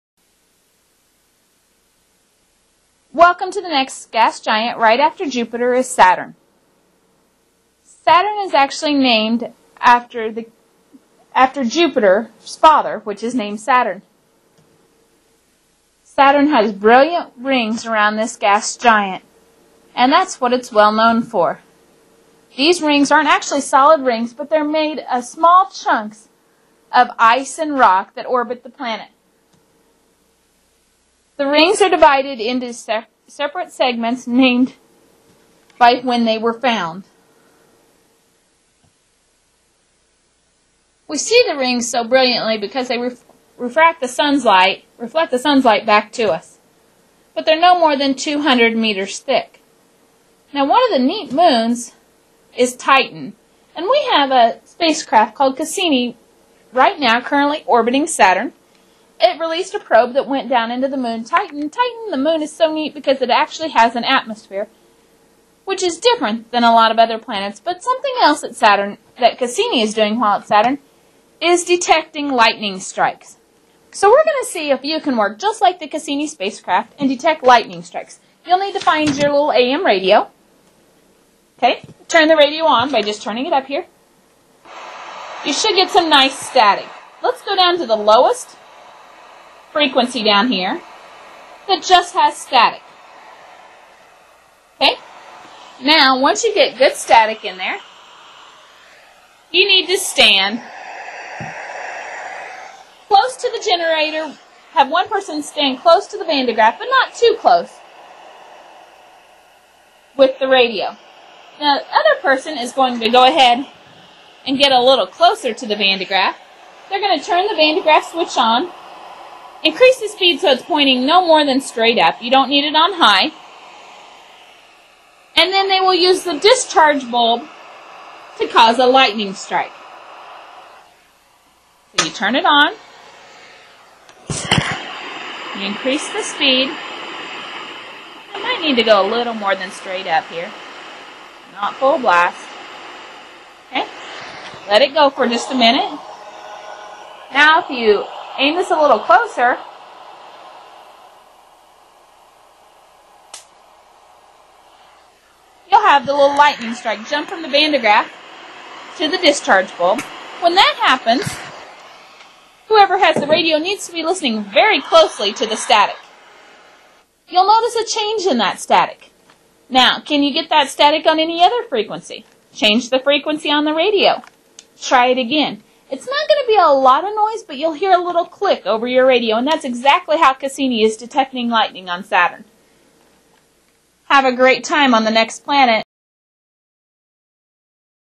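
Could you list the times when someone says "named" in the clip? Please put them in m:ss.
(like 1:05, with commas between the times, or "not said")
0:08, 0:13, 0:34.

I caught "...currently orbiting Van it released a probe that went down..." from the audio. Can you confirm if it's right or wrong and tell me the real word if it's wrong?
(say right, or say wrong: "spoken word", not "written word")
wrong: "Saturn", not "Van".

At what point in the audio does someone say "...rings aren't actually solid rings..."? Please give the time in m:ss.
0:22.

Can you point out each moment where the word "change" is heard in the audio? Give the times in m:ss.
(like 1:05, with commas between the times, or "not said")
2:47, 2:52.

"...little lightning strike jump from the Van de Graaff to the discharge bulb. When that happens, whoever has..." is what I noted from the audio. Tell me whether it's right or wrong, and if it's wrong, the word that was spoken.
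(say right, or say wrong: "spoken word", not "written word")
right.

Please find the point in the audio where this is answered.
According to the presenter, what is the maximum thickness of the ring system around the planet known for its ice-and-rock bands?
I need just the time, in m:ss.
0:48.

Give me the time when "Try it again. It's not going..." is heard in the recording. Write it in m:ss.
2:54.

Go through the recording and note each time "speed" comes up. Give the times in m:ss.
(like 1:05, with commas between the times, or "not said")
2:00, 2:16.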